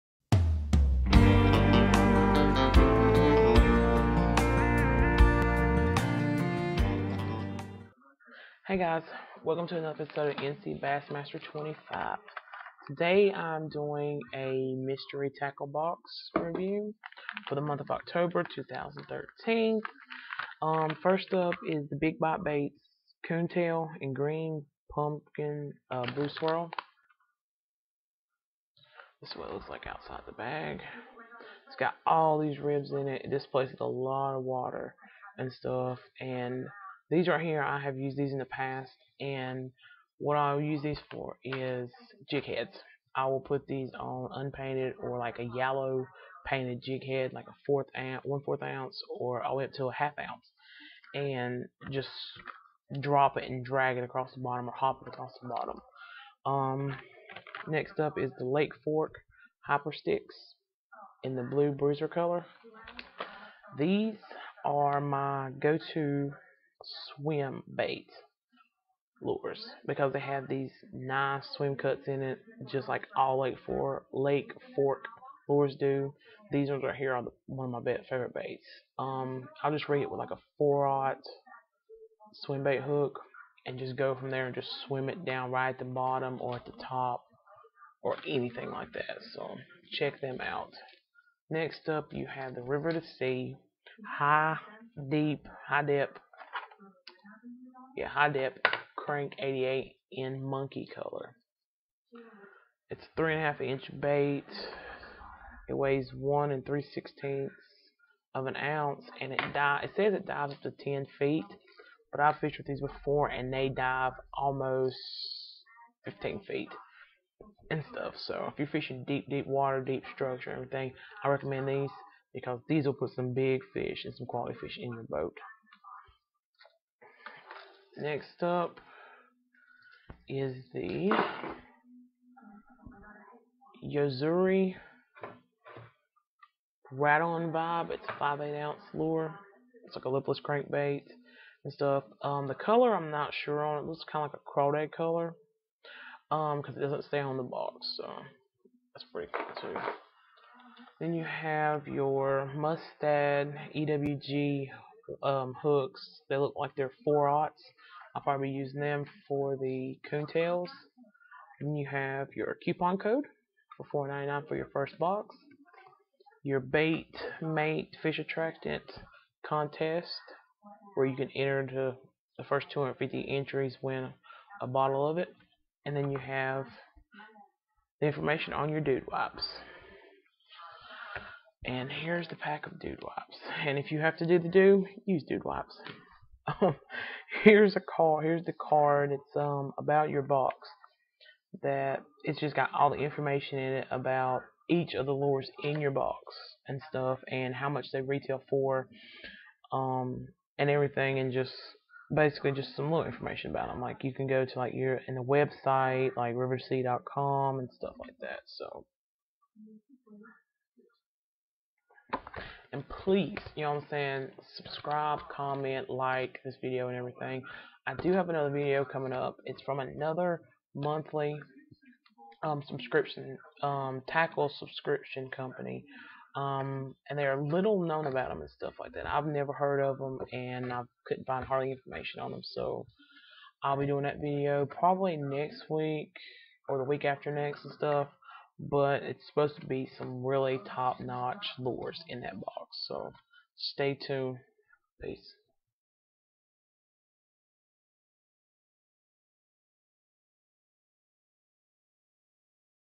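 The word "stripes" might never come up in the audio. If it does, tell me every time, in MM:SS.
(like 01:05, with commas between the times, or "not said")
not said.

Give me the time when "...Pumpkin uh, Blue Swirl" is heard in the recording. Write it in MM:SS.
00:24.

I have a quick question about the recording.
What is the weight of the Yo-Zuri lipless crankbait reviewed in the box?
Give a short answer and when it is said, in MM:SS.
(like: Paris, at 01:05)
5/8 ounce, at 02:18.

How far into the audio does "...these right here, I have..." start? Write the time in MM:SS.
00:37.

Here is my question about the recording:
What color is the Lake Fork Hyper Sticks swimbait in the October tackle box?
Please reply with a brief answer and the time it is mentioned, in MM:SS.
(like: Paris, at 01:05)
blue bruiser, at 01:01.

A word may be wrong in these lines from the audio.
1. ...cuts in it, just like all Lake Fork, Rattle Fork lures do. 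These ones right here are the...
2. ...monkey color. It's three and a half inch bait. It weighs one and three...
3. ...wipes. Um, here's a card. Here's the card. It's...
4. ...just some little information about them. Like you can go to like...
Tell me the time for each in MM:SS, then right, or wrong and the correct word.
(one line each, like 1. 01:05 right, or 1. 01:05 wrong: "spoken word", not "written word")
1. 01:11 wrong: "Lake", not "Rattle"
2. 01:40 right
3. 03:05 right
4. 03:22 right.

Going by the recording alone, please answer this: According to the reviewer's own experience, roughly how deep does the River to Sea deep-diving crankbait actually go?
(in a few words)
almost 15 feet.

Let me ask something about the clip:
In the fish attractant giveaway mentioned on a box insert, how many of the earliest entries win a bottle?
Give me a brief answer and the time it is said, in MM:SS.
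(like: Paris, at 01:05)
250, at 02:52.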